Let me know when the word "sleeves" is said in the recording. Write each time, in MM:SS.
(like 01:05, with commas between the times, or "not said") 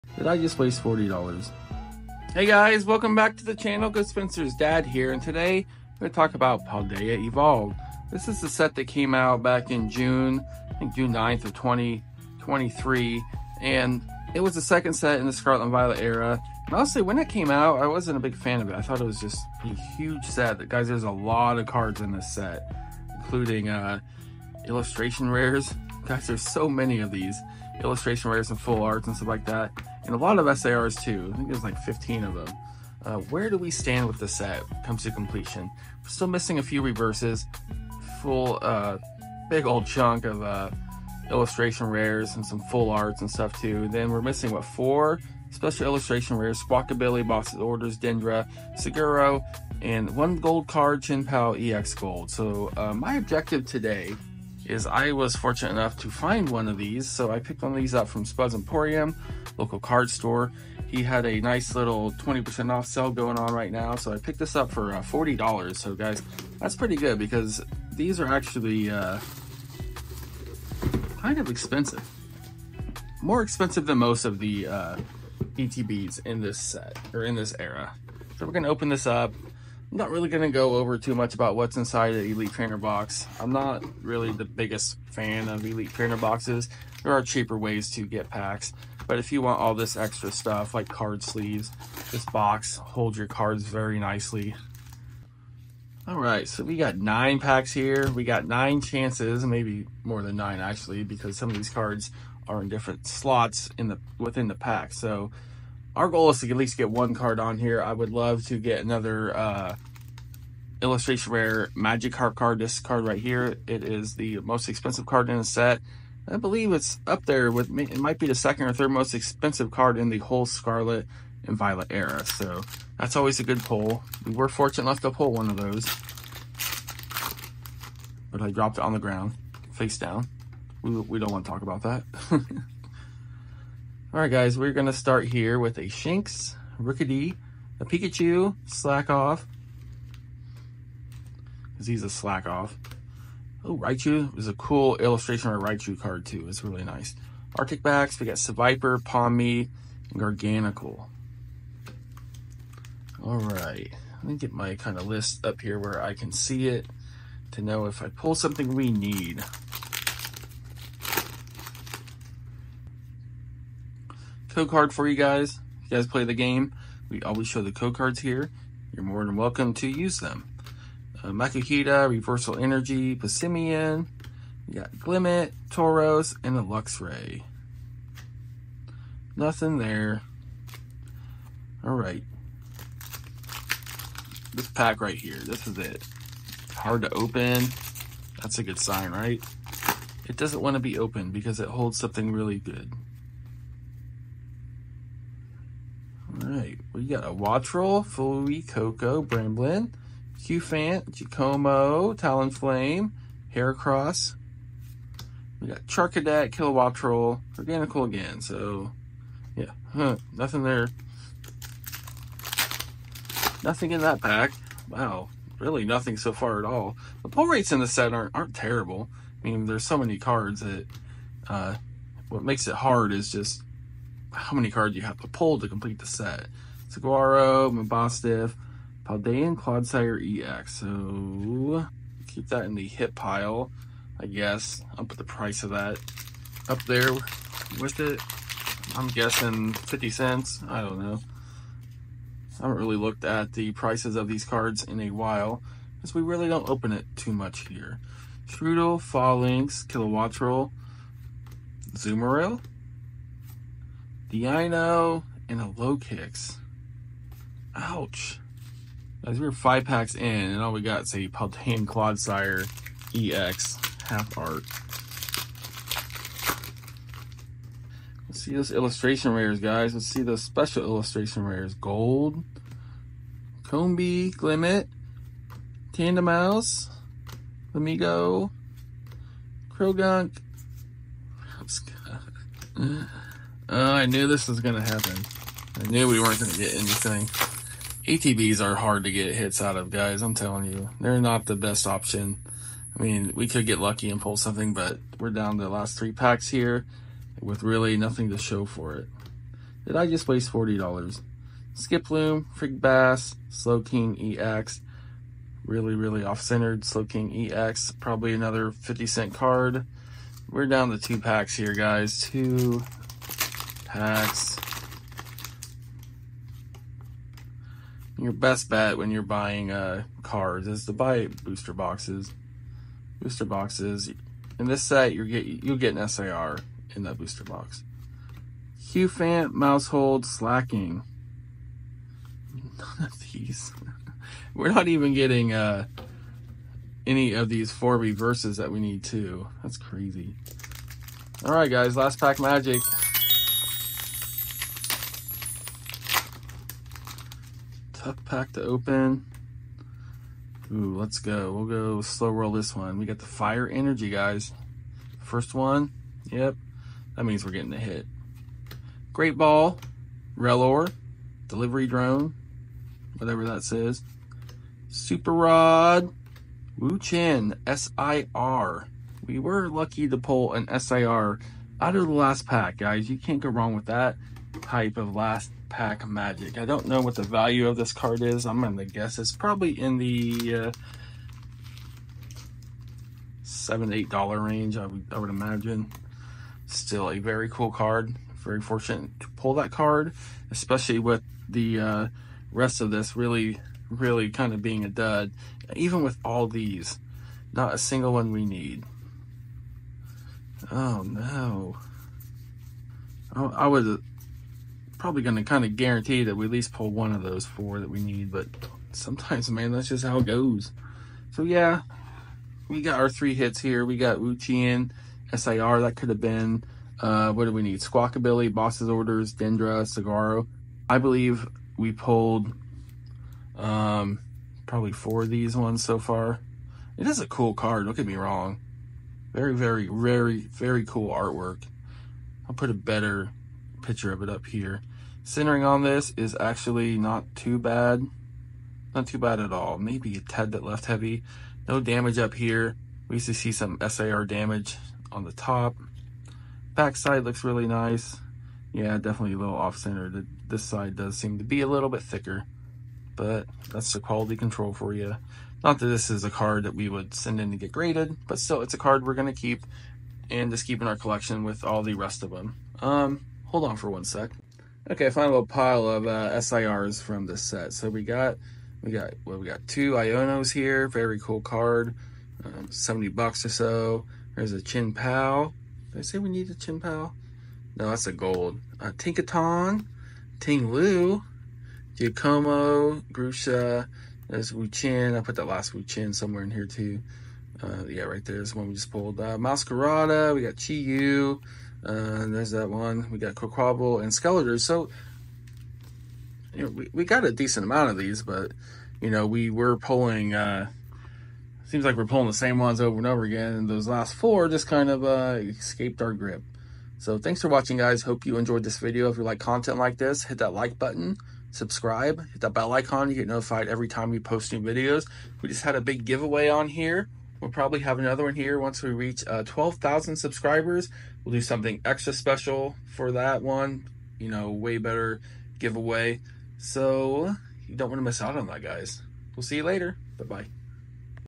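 01:31.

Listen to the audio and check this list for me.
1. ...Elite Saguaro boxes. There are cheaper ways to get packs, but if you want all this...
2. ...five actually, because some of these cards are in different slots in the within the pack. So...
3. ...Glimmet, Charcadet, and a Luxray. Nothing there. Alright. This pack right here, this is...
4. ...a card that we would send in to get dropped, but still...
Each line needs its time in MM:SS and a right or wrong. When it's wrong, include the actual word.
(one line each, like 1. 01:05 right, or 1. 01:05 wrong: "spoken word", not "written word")
1. 01:25 wrong: "Trainer", not "Saguaro"
2. 01:40 wrong: "nine", not "five"
3. 02:54 wrong: "Tauros", not "Charcadet"
4. 07:36 wrong: "graded", not "dropped".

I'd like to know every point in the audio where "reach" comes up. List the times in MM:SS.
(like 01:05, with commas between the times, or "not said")
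08:38.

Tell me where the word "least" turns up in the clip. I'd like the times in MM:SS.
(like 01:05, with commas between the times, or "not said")
01:46, 06:46.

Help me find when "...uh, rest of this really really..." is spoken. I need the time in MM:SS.
06:31.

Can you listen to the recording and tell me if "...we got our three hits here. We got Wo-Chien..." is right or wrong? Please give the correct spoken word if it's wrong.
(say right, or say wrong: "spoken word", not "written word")
right.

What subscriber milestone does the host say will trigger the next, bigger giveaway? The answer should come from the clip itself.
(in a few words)
12,000.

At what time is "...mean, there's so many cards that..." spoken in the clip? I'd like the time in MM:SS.
03:39.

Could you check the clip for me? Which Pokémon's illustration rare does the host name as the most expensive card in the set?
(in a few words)
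Magikarp.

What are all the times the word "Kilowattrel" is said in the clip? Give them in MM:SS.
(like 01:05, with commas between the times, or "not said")
03:26, 04:09.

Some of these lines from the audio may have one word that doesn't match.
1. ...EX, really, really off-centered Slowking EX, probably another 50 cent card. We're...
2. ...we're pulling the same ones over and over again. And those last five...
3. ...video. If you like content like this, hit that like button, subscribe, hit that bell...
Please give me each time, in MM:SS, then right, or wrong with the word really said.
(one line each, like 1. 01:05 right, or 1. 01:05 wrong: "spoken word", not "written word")
1. 05:04 right
2. 08:21 wrong: "four", not "five"
3. 08:28 right.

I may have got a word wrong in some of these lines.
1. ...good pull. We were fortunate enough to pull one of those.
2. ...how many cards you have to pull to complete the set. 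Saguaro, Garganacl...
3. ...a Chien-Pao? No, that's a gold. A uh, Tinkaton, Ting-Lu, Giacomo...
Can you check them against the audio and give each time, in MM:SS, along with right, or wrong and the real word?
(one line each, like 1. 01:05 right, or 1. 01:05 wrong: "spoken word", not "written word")
1. 02:03 right
2. 03:44 wrong: "Mabosstiff", not "Garganacl"
3. 07:56 right.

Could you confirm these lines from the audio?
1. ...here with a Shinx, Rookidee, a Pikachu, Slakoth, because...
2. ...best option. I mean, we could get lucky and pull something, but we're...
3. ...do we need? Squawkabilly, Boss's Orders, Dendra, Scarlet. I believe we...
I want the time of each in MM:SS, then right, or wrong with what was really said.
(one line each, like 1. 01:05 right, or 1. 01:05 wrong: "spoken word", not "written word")
1. 02:15 right
2. 04:51 right
3. 06:57 wrong: "Saguaro", not "Scarlet".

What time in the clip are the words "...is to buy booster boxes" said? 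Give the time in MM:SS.
05:20.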